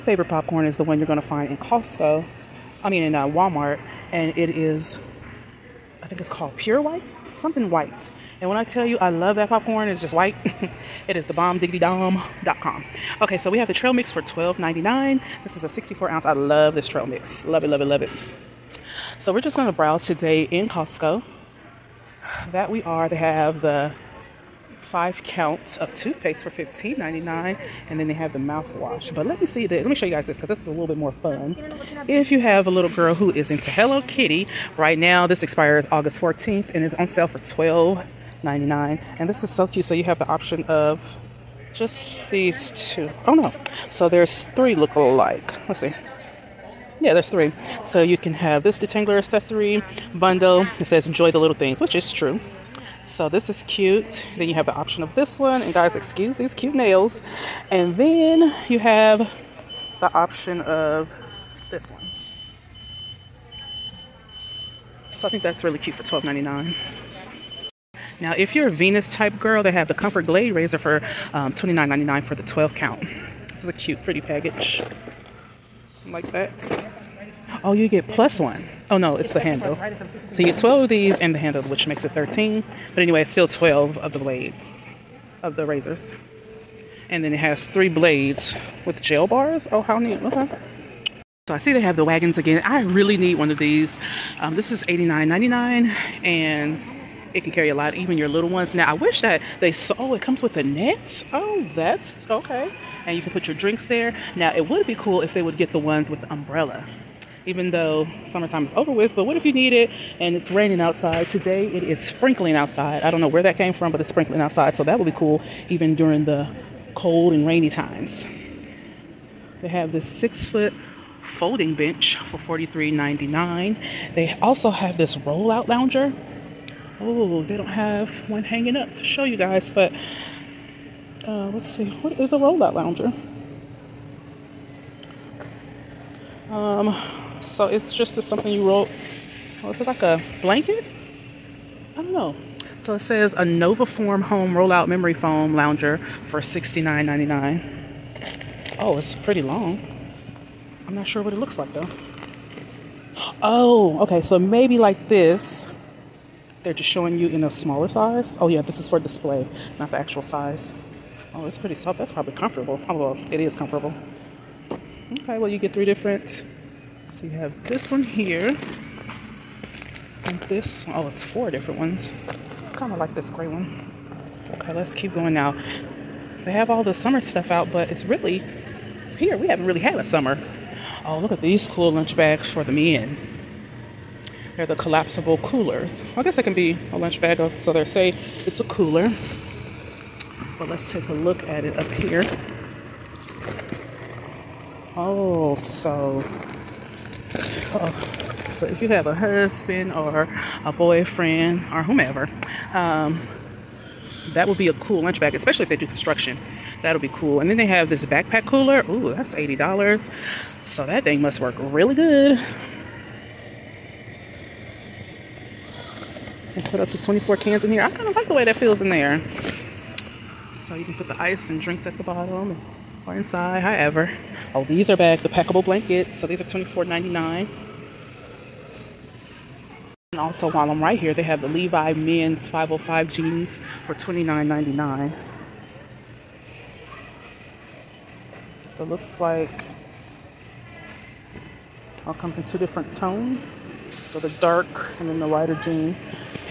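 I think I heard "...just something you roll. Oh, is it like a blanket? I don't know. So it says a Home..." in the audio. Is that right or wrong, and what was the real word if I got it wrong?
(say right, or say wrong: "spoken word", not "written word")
wrong: "Novaform", not "Home".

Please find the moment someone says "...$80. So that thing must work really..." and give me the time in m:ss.
3:29.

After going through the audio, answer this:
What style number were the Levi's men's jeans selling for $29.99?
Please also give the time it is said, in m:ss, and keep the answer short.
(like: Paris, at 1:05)
505, at 3:52.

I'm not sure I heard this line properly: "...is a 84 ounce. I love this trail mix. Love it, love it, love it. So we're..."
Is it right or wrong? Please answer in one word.
wrong.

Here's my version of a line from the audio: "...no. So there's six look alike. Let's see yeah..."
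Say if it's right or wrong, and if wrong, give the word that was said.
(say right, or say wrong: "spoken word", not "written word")
wrong: "three", not "six".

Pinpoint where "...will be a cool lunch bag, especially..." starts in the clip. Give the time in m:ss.
3:24.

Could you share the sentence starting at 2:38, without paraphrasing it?
Oh yeah, this is for display, not the actual size.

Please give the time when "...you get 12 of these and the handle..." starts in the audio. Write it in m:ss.
1:20.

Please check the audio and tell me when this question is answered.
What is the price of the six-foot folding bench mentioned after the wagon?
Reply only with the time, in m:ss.
2:02.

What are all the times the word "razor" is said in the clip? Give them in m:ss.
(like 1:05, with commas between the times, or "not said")
1:10, 1:25.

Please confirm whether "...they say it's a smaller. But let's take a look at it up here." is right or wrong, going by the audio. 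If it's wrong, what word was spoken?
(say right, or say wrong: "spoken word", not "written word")
wrong: "cooler", not "smaller".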